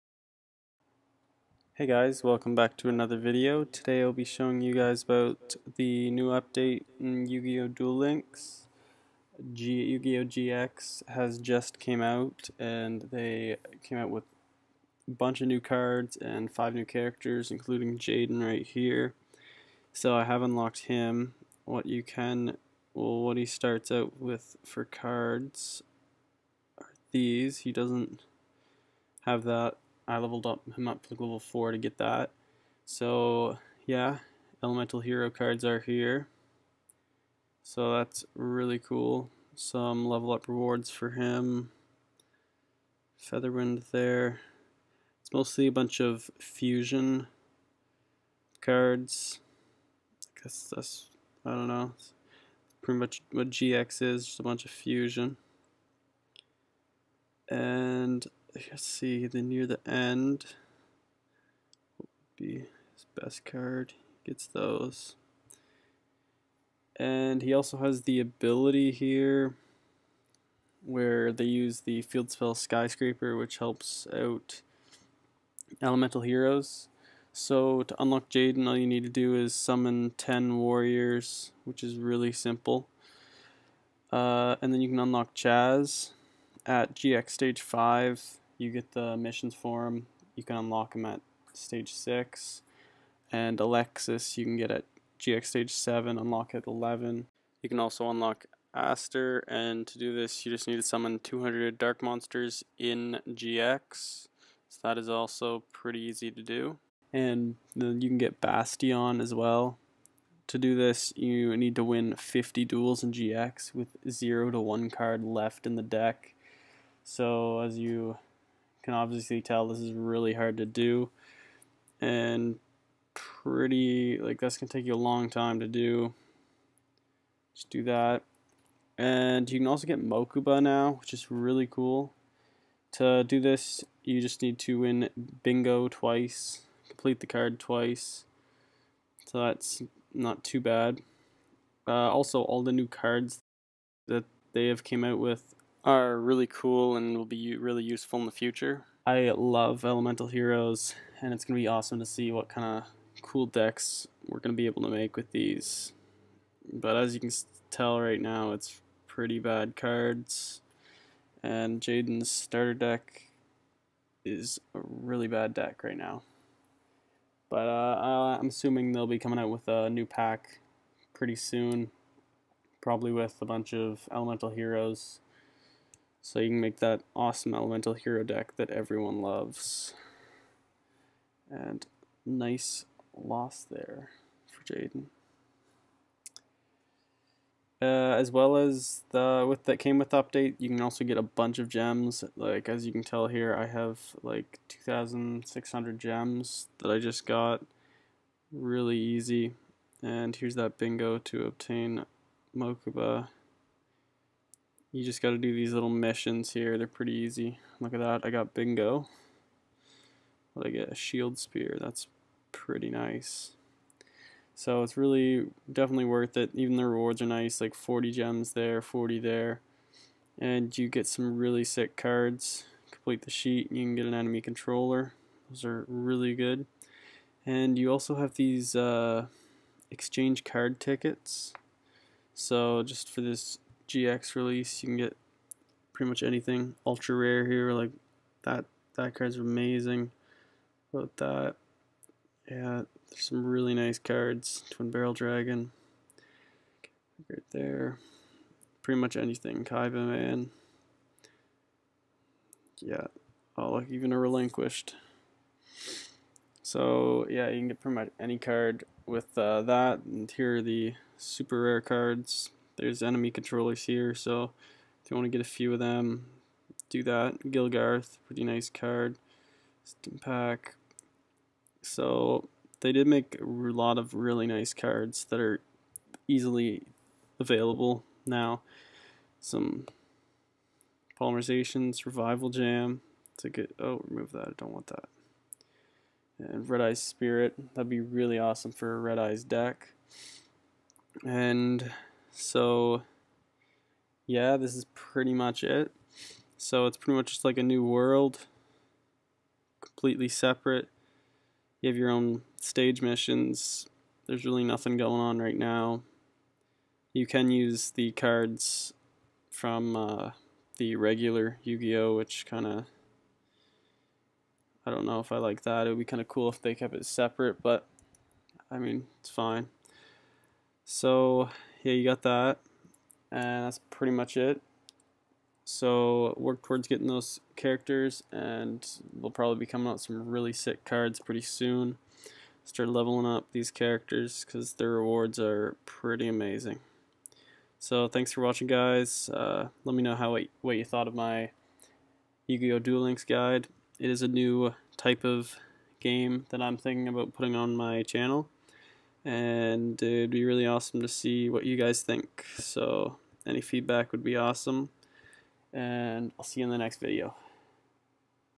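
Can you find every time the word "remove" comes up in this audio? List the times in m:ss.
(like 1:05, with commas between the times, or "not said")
4:44.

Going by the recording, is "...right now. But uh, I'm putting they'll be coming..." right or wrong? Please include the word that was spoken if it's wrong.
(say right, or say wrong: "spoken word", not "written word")
wrong: "assuming", not "putting".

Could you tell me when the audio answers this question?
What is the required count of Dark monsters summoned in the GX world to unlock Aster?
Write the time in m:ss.
1:41.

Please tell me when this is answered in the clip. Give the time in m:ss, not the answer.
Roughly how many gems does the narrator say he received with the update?
3:14.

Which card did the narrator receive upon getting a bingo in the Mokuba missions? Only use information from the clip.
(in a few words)
Shield Spear.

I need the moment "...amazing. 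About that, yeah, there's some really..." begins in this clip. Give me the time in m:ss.
3:59.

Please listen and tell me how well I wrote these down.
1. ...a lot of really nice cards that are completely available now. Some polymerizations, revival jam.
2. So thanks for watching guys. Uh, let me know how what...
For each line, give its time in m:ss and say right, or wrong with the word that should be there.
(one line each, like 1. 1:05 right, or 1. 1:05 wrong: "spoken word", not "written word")
1. 4:33 wrong: "easily", not "completely"
2. 5:37 right.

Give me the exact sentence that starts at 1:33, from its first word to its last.
And Alexis, you can get at GX stage 7, unlock at 11.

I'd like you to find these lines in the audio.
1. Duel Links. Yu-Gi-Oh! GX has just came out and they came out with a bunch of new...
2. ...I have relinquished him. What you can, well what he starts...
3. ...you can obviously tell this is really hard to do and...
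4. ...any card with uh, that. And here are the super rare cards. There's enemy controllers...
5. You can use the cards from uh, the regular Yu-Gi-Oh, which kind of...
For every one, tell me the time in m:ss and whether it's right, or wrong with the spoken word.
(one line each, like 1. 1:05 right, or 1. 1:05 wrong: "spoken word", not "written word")
1. 0:07 right
2. 0:20 wrong: "unlocked", not "relinquished"
3. 1:57 right
4. 4:18 right
5. 5:07 right.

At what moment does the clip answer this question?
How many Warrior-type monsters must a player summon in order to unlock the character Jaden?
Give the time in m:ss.
1:20.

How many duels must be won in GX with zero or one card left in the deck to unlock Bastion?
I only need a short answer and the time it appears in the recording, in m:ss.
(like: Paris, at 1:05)
50, at 1:52.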